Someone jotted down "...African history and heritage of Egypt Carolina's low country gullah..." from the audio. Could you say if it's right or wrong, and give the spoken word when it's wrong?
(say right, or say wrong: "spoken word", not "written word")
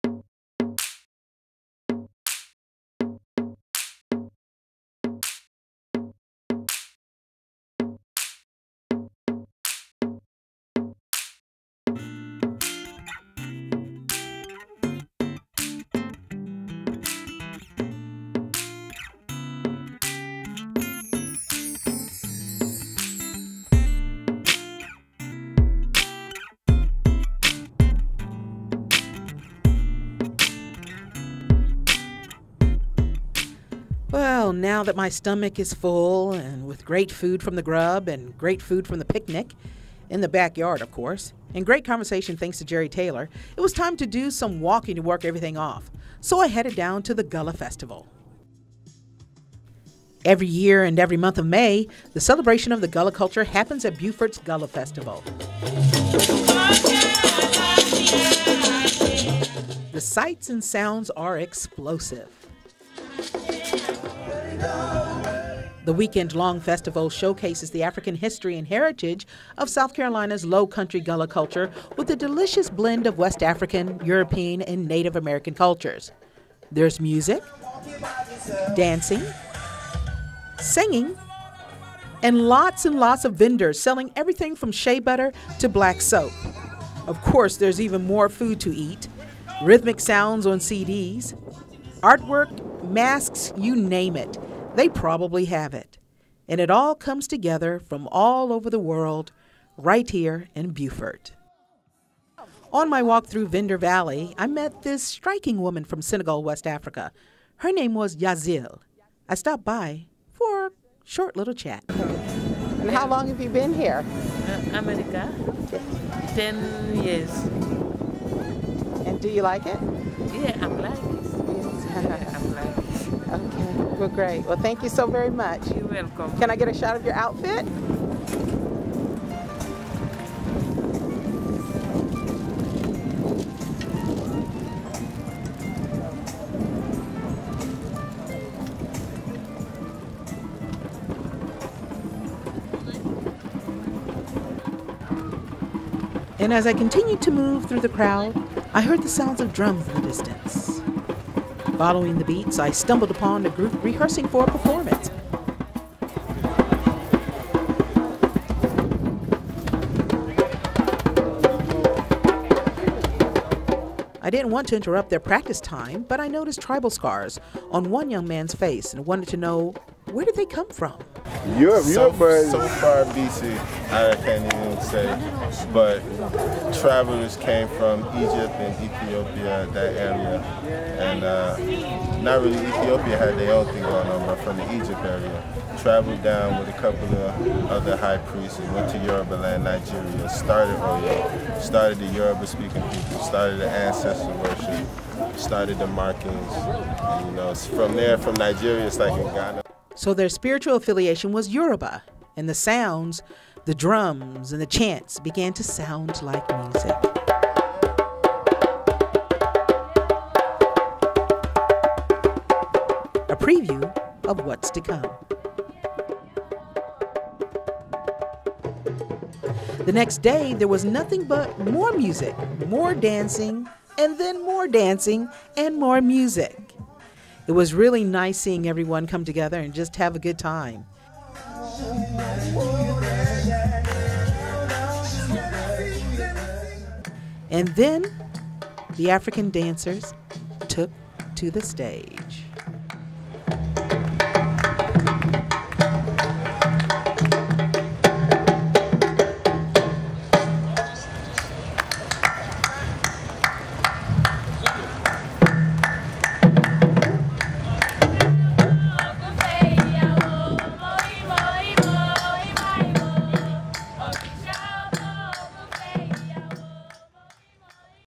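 wrong: "South", not "Egypt".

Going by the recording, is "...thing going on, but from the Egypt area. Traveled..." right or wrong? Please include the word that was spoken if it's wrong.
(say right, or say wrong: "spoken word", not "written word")
right.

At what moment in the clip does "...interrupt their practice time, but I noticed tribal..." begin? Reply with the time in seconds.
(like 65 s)
164 s.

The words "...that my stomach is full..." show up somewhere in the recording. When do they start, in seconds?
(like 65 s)
34 s.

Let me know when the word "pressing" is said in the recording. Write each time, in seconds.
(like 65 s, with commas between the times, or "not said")
not said.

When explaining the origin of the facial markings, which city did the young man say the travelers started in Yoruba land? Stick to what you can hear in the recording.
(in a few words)
Oyo.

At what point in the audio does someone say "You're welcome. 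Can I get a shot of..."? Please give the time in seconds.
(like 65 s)
125 s.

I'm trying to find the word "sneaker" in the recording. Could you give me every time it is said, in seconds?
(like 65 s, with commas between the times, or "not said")
not said.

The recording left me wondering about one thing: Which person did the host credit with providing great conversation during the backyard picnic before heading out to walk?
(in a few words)
Jerry Taylor.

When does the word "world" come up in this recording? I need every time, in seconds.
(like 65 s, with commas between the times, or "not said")
98 s.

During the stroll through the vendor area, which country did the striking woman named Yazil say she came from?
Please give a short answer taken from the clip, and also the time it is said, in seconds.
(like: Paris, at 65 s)
Senegal, at 106 s.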